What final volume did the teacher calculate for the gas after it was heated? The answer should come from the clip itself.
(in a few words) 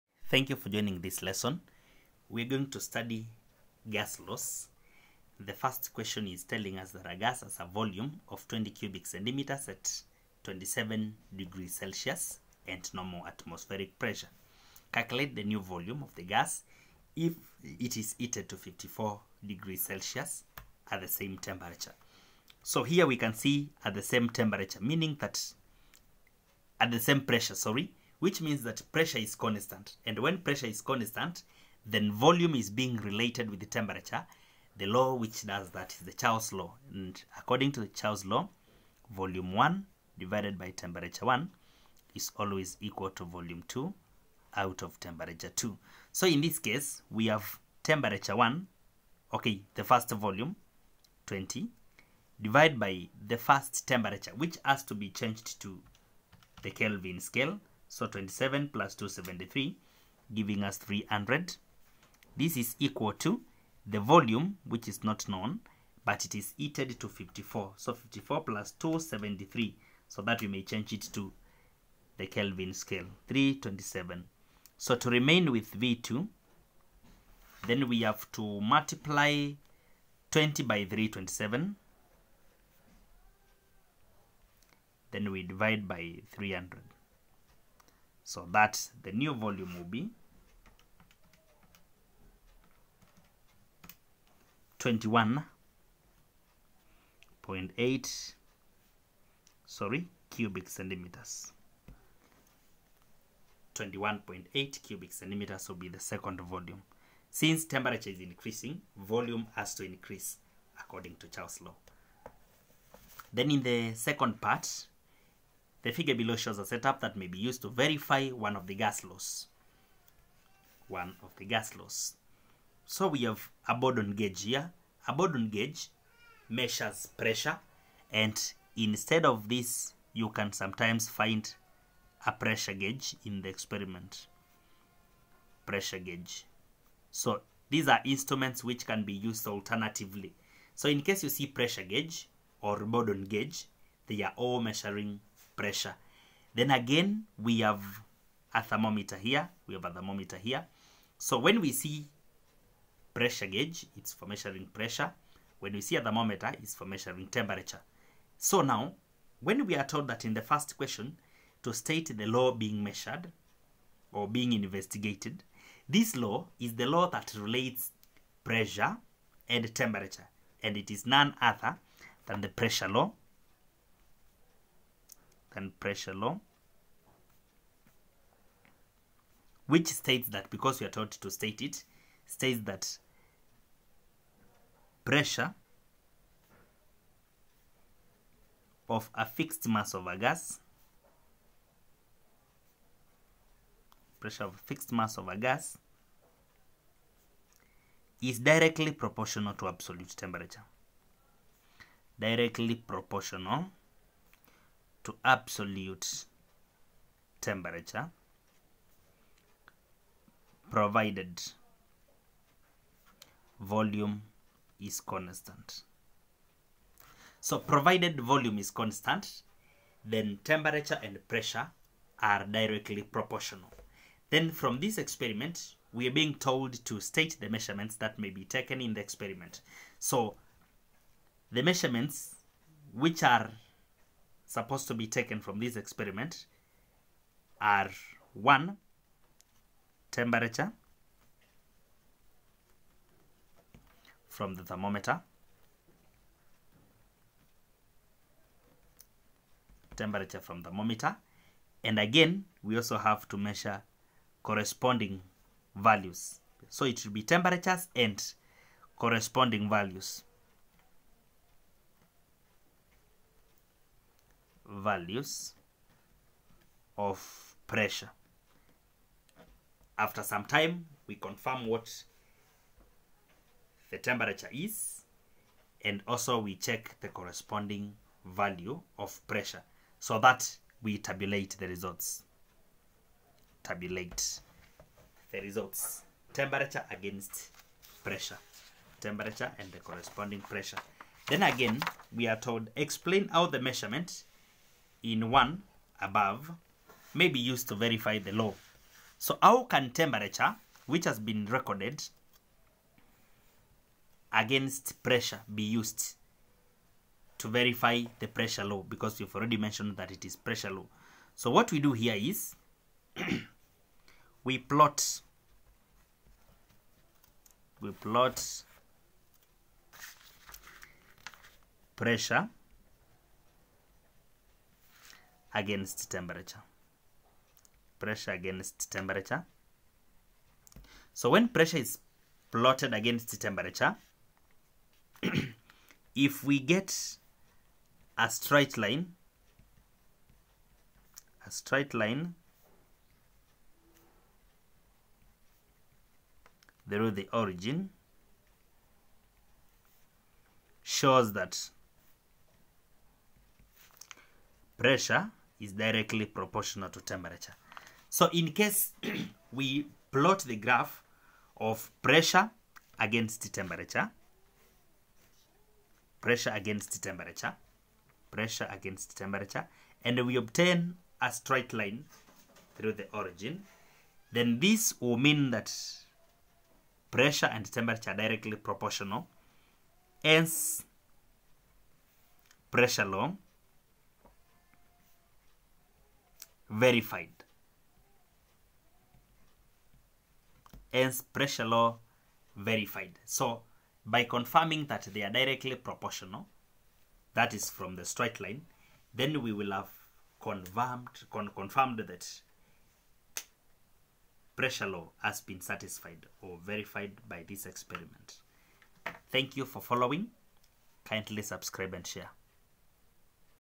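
21.8 cubic centimeters.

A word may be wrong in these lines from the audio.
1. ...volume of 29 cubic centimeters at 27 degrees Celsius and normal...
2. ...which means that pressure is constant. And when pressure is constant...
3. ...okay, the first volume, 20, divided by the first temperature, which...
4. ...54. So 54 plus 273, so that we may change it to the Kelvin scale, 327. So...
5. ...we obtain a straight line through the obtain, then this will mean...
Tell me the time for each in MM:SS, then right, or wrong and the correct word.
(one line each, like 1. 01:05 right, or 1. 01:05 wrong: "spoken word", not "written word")
1. 00:07 wrong: "20", not "29"
2. 00:28 right
3. 00:49 right
4. 01:07 right
5. 06:10 wrong: "origin", not "obtain".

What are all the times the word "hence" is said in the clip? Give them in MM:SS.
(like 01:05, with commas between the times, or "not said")
06:20, 06:30.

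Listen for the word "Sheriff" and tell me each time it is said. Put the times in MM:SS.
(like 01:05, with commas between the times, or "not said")
not said.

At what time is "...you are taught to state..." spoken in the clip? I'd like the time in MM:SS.
03:00.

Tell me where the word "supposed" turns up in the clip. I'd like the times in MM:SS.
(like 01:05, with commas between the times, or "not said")
03:54.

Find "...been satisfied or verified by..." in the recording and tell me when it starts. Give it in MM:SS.
06:45.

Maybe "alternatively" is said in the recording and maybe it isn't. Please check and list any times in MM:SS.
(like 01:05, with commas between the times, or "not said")
02:19.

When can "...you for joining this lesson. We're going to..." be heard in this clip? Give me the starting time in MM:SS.
00:00.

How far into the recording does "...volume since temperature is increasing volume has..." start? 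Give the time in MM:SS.
01:46.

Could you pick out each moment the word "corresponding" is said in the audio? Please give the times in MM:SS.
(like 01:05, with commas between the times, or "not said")
04:14, 04:18, 04:37, 04:49.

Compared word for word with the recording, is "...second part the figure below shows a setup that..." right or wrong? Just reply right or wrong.
right.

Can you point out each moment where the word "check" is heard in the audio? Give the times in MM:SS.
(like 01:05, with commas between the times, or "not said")
04:36.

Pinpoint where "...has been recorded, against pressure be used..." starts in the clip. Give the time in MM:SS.
05:01.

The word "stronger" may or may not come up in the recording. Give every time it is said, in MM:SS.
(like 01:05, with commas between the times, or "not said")
not said.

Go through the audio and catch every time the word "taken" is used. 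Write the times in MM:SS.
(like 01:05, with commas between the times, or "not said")
03:48, 03:55.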